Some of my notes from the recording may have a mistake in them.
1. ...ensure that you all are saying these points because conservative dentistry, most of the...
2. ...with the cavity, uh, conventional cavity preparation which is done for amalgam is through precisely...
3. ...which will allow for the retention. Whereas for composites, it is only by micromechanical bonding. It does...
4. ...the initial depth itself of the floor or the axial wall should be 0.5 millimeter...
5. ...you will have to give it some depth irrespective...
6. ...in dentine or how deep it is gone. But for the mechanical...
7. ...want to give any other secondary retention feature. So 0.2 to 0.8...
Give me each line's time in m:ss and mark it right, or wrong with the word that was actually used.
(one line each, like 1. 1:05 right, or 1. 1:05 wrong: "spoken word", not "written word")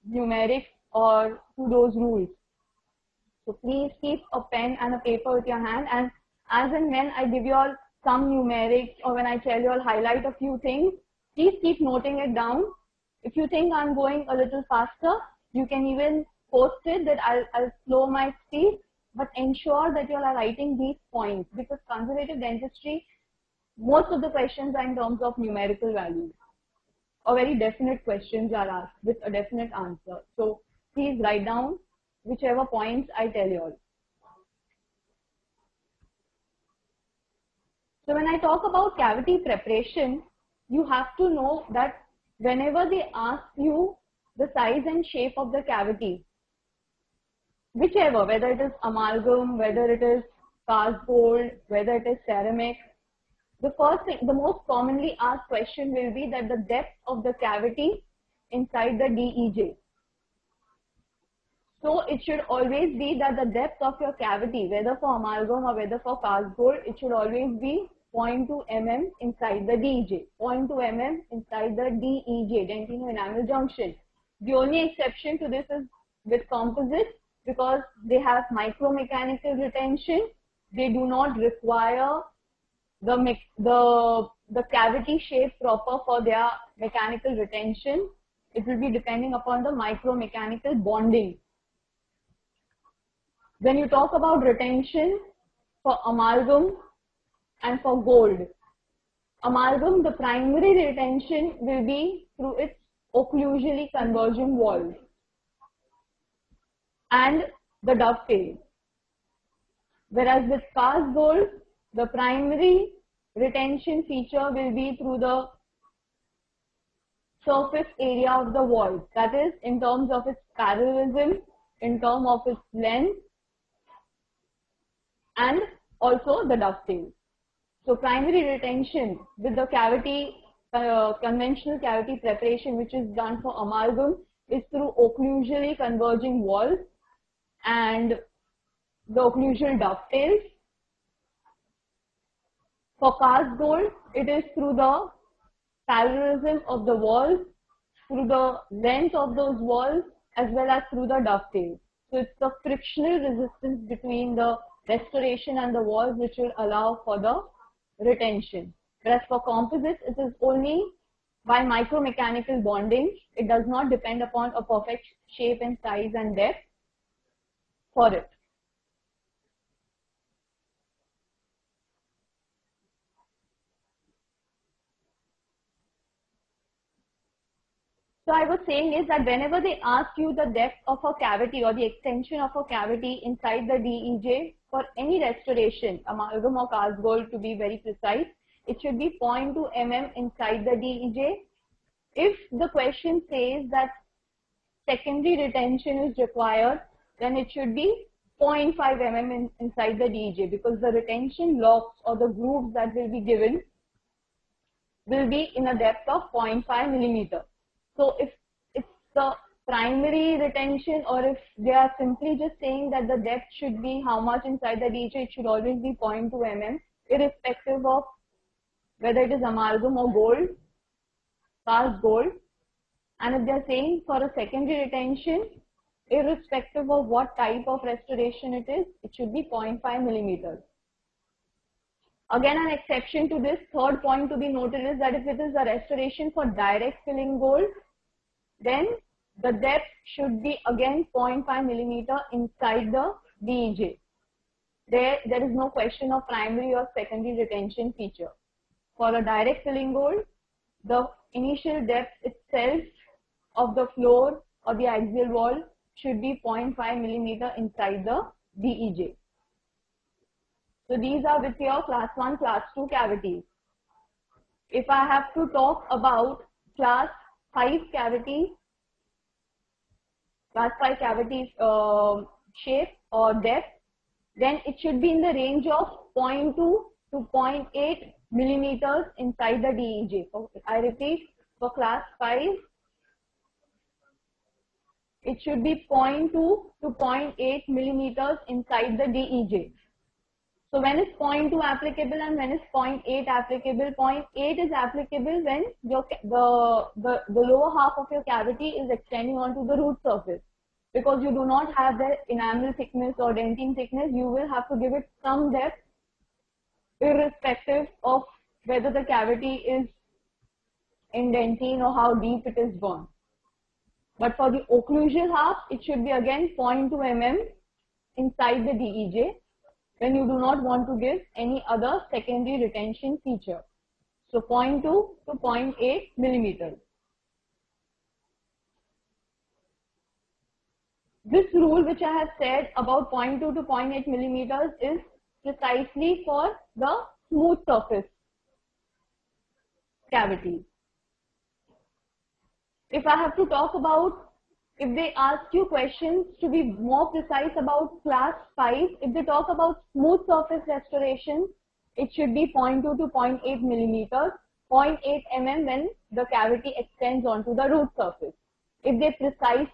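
1. 0:19 wrong: "writing", not "saying"
2. 2:09 wrong: "occlusally", not "precisely"
3. 2:36 right
4. 4:10 right
5. 5:04 right
6. 5:11 wrong: "occlusal", not "mechanical"
7. 5:20 right.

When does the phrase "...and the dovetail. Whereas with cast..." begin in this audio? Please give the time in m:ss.
1:47.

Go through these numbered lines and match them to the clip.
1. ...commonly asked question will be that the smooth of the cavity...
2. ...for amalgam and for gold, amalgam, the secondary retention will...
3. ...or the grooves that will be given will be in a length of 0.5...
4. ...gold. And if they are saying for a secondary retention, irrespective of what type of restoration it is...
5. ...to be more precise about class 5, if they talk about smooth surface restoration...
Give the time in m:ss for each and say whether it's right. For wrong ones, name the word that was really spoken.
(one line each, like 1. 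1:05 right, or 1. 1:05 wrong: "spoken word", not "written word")
1. 0:54 wrong: "depth", not "smooth"
2. 1:35 wrong: "primary", not "secondary"
3. 3:22 wrong: "depth", not "length"
4. 3:42 right
5. 5:46 right.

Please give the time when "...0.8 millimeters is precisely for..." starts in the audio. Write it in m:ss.
5:33.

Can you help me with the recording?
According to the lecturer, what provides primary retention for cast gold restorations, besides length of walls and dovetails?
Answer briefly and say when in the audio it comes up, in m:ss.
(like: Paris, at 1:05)
Parallelism of the walls, at 2:24.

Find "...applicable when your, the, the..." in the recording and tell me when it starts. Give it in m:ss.
4:54.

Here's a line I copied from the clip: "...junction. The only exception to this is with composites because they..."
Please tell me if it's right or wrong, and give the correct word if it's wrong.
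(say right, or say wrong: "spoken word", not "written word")
right.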